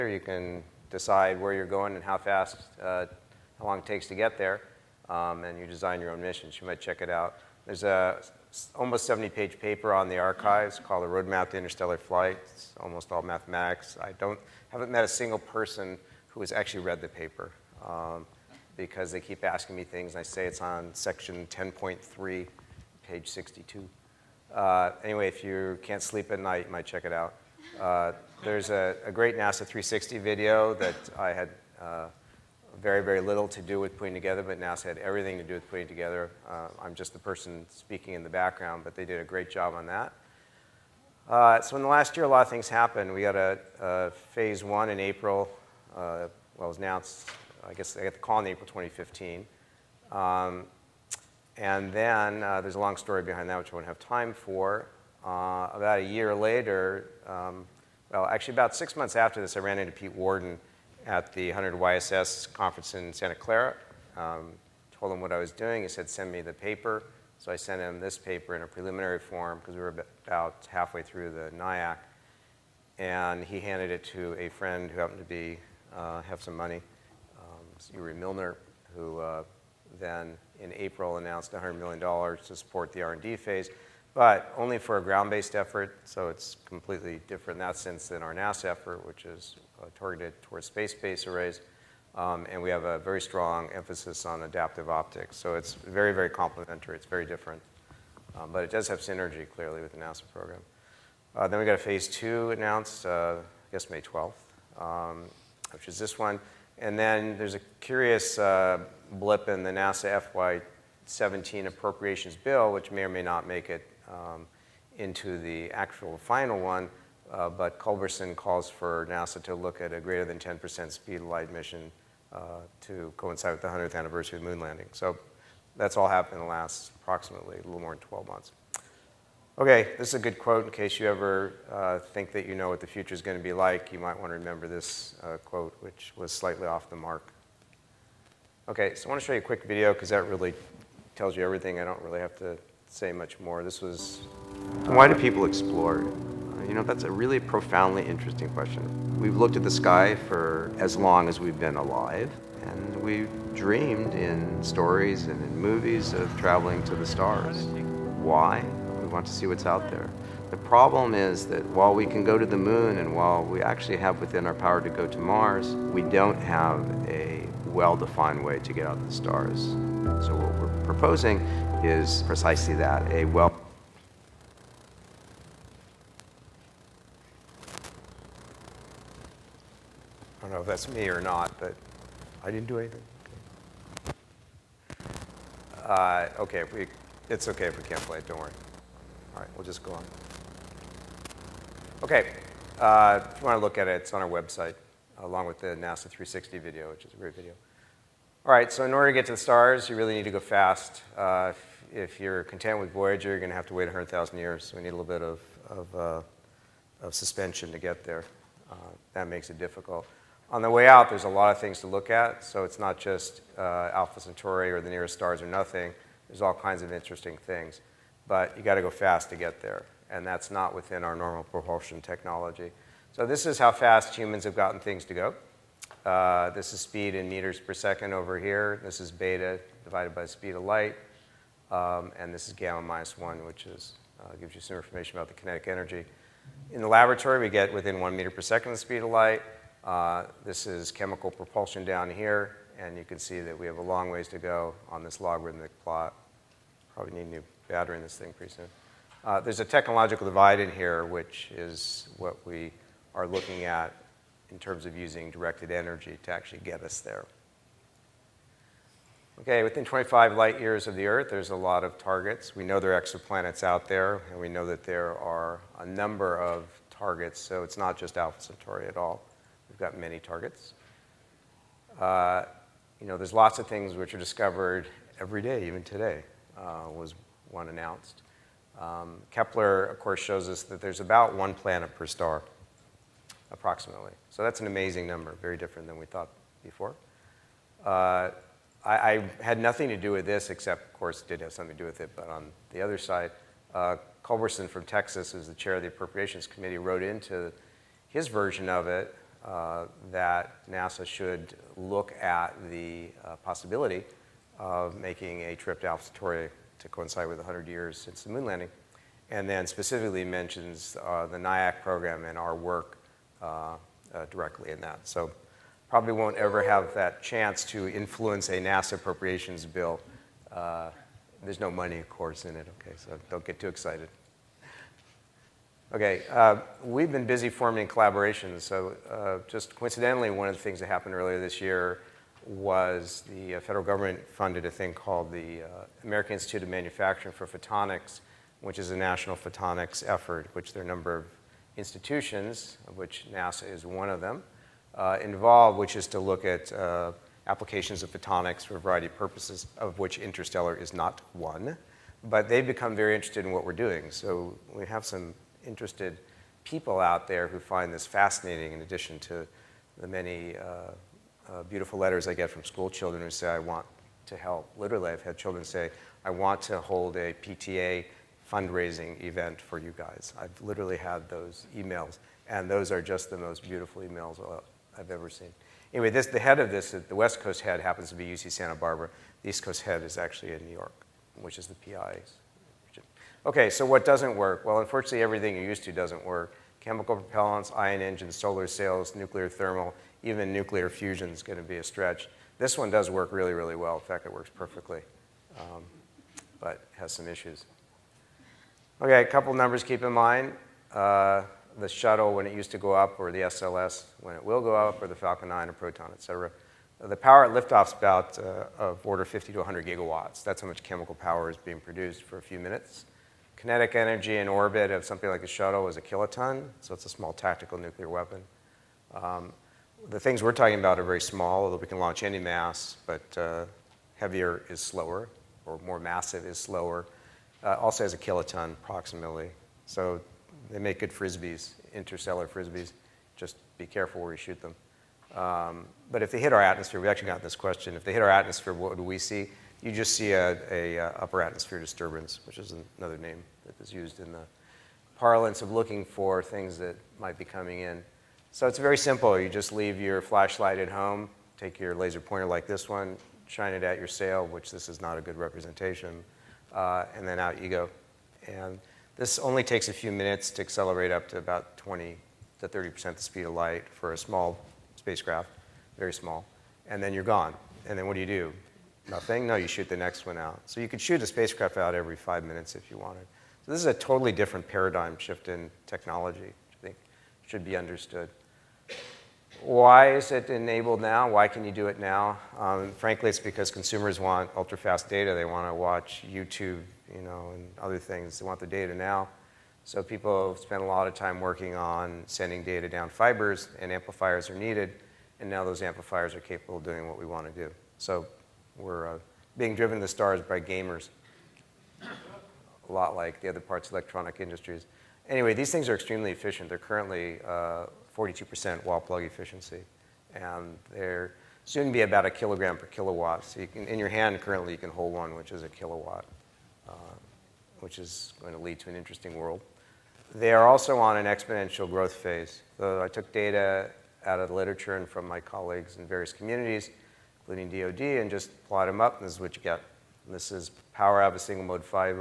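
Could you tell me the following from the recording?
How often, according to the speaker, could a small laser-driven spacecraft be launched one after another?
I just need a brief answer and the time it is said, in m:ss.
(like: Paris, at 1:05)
every five minutes, at 7:51.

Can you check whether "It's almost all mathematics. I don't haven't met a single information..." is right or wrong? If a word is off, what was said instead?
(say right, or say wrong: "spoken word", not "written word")
wrong: "person", not "information".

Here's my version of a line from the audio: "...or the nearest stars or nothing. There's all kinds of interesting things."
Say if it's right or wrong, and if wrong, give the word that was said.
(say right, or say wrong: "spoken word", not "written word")
right.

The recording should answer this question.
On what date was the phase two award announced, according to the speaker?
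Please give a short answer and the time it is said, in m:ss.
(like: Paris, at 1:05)
May 12th, at 1:43.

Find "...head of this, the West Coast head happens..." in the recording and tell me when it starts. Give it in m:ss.
6:16.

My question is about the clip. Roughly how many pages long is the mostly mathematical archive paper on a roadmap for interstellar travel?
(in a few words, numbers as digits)
almost 70.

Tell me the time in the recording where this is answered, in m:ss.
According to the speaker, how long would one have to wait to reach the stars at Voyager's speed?
3:23.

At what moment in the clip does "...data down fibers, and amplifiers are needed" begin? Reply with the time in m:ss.
8:12.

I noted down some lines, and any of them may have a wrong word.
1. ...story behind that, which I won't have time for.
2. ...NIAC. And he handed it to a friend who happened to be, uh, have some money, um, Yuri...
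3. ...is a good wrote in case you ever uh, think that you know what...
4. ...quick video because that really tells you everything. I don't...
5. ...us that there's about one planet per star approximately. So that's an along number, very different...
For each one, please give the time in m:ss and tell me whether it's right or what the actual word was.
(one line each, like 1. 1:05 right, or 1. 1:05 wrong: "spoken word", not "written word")
1. 0:52 right
2. 1:11 right
3. 2:10 wrong: "quote", not "wrote"
4. 2:19 right
5. 4:40 wrong: "amazing", not "along".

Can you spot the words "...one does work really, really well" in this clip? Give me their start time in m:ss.
6:32.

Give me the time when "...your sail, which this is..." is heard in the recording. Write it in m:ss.
7:33.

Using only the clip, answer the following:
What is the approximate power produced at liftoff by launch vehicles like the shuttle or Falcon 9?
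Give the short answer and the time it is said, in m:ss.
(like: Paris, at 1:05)
50 to 100 gigawatts, at 6:49.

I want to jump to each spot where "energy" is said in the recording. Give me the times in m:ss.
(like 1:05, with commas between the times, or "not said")
3:55, 4:15, 6:53.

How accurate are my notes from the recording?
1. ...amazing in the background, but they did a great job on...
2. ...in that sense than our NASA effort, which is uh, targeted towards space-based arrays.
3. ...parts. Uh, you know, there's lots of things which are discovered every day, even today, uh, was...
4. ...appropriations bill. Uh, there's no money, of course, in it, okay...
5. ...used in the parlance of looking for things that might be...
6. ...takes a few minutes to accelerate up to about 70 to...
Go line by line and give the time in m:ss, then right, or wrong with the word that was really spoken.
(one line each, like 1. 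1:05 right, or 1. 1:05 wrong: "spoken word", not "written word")
1. 0:37 wrong: "speaking", not "amazing"
2. 1:27 right
3. 4:30 wrong: "targets", not "parts"
4. 5:18 right
5. 7:23 right
6. 7:39 wrong: "20", not "70".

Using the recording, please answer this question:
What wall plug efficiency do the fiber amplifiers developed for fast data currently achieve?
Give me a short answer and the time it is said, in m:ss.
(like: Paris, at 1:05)
42%, at 8:28.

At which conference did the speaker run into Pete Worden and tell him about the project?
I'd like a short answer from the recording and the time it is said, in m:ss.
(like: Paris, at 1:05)
100 YSS, at 1:01.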